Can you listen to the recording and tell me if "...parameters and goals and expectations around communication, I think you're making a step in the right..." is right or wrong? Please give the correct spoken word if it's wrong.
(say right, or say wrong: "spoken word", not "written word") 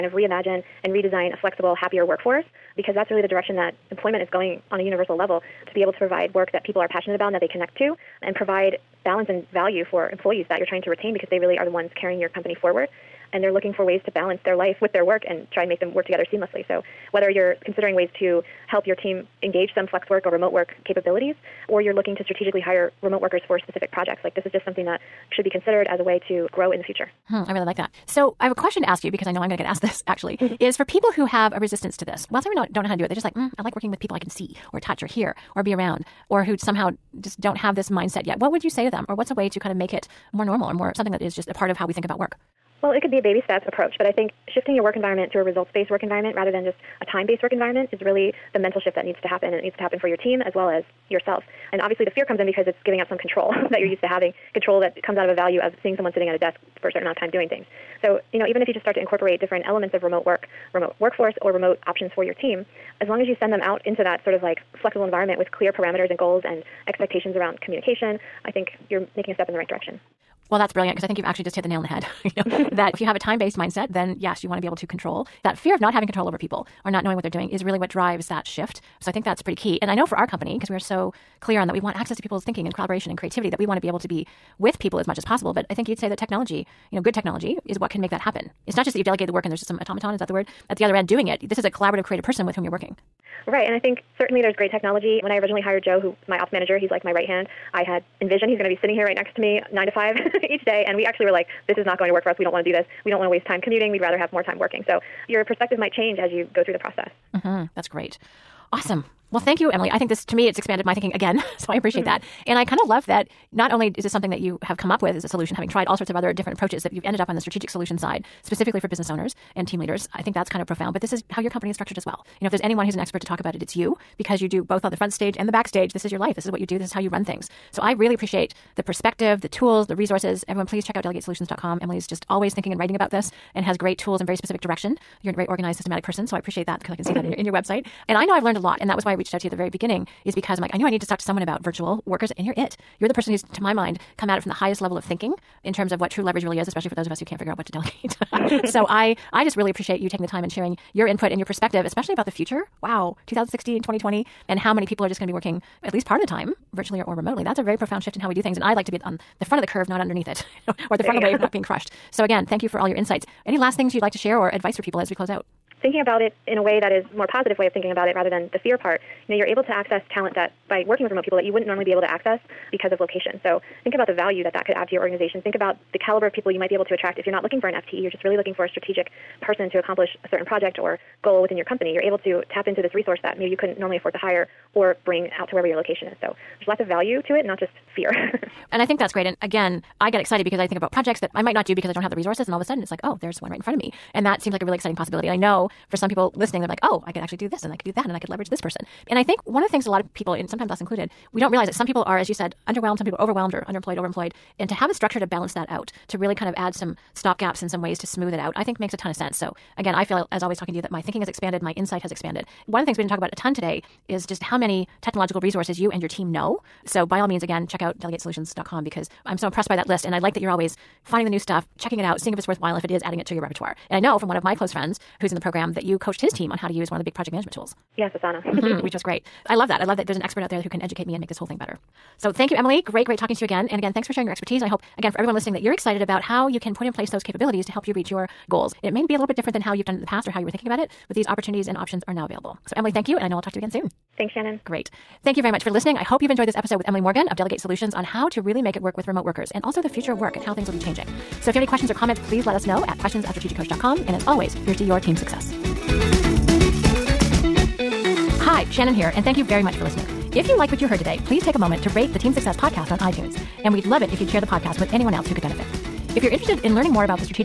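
right.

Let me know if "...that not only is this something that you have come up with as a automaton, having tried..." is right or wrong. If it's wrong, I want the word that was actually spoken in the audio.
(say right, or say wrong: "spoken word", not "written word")
wrong: "solution", not "automaton".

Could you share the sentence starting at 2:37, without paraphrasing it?
That's a very profound shift in how we do things.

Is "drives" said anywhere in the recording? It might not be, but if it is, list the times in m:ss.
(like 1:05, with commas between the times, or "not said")
1:17.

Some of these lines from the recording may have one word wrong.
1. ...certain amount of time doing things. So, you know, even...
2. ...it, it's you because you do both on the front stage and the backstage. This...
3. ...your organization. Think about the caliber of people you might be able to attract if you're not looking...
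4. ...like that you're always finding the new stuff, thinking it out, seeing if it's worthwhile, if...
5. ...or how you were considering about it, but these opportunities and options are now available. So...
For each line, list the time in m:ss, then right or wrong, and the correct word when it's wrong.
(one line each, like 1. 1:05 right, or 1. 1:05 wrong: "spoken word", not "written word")
1. 0:56 right
2. 2:03 right
3. 2:54 right
4. 3:40 wrong: "checking", not "thinking"
5. 4:00 wrong: "thinking", not "considering".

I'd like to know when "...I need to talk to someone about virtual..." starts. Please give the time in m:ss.
2:20.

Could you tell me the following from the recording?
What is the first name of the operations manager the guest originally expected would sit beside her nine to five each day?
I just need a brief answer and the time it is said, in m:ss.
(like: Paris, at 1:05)
Joe, at 1:35.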